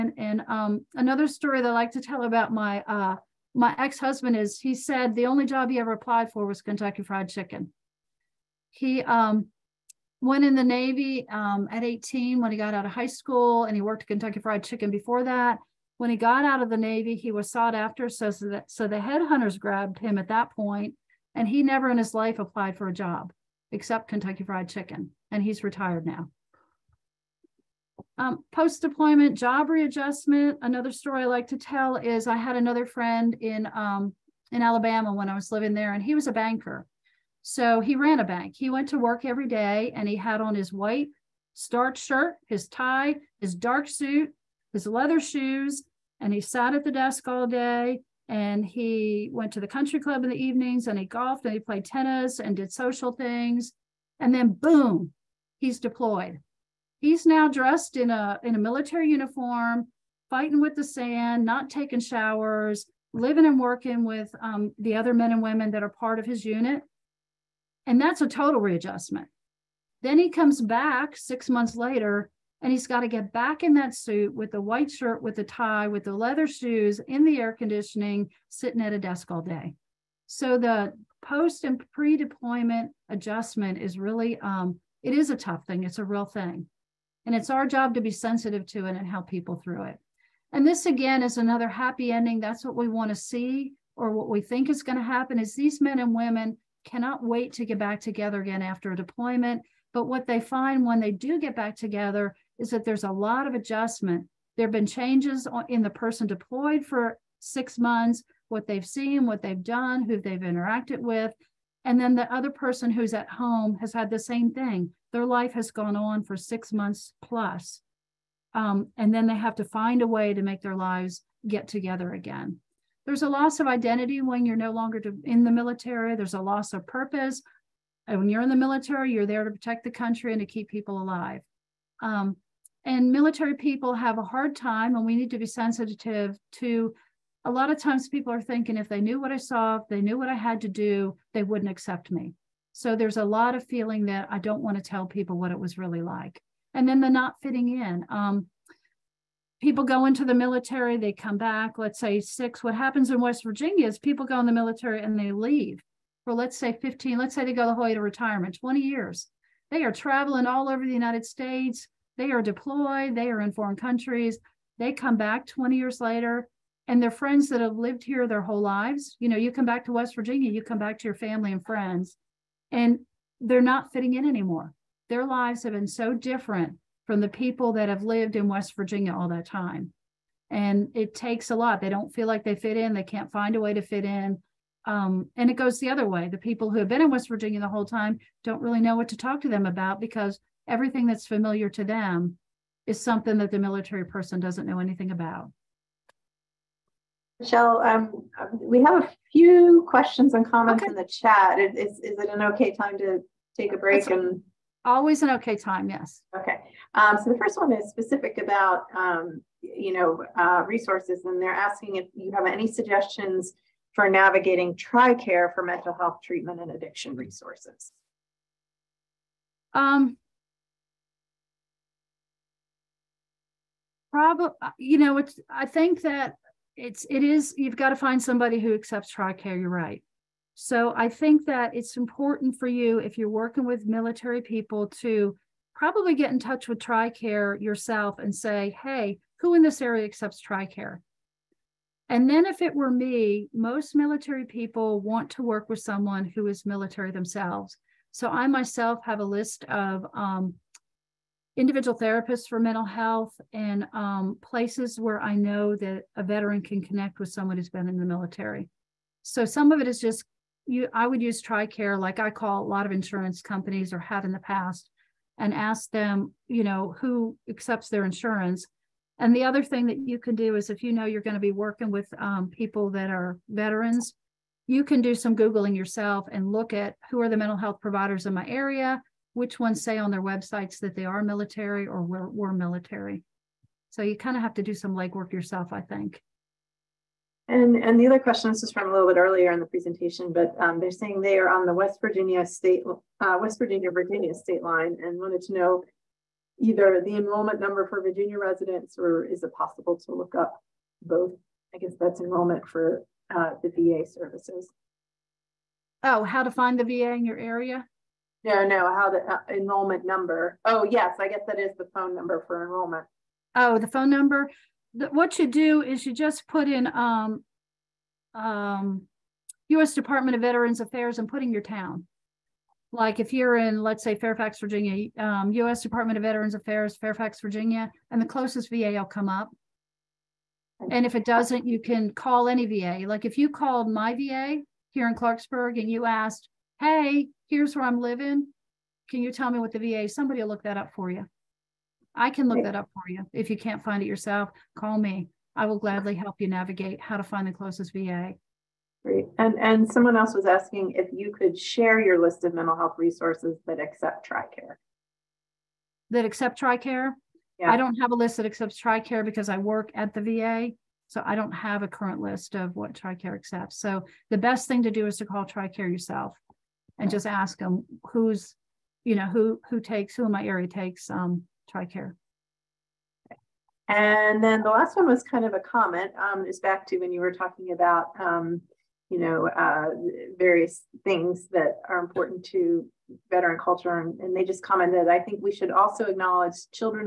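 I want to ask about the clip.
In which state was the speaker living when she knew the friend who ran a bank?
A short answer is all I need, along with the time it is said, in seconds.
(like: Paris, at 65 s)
Alabama, at 34 s.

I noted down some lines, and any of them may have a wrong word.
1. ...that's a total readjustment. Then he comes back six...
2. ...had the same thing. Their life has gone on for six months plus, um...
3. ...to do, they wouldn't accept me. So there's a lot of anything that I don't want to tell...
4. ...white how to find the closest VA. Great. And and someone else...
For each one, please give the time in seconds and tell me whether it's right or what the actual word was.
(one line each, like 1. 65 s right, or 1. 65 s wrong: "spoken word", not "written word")
1. 68 s right
2. 113 s right
3. 140 s wrong: "feeling", not "anything"
4. 346 s wrong: "navigate", not "white".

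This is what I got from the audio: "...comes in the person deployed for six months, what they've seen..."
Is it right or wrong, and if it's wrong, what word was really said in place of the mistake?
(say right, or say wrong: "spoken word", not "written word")
wrong: "changes", not "comes".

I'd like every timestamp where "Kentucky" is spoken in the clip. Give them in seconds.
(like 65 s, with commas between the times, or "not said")
6 s, 14 s, 24 s.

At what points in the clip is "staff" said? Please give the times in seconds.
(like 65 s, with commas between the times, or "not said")
not said.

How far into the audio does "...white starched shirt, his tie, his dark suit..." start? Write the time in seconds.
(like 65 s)
40 s.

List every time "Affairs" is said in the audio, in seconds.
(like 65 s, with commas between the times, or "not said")
320 s, 326 s.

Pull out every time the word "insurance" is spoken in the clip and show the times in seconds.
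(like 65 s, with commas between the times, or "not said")
262 s, 268 s.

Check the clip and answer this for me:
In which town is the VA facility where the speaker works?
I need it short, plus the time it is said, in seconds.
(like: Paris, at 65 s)
Clarksburg, at 335 s.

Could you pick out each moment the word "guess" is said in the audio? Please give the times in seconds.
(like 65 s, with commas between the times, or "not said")
301 s, 311 s.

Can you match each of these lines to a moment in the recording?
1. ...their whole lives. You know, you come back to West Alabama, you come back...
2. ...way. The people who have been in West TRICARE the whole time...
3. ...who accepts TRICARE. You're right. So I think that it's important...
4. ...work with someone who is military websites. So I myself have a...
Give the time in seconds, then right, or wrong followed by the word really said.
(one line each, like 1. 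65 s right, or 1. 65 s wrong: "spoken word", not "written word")
1. 168 s wrong: "Virginia", not "Alabama"
2. 186 s wrong: "Virginia", not "TRICARE"
3. 228 s right
4. 245 s wrong: "themselves", not "websites".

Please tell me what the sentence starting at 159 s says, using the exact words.
They are traveling all over the United States.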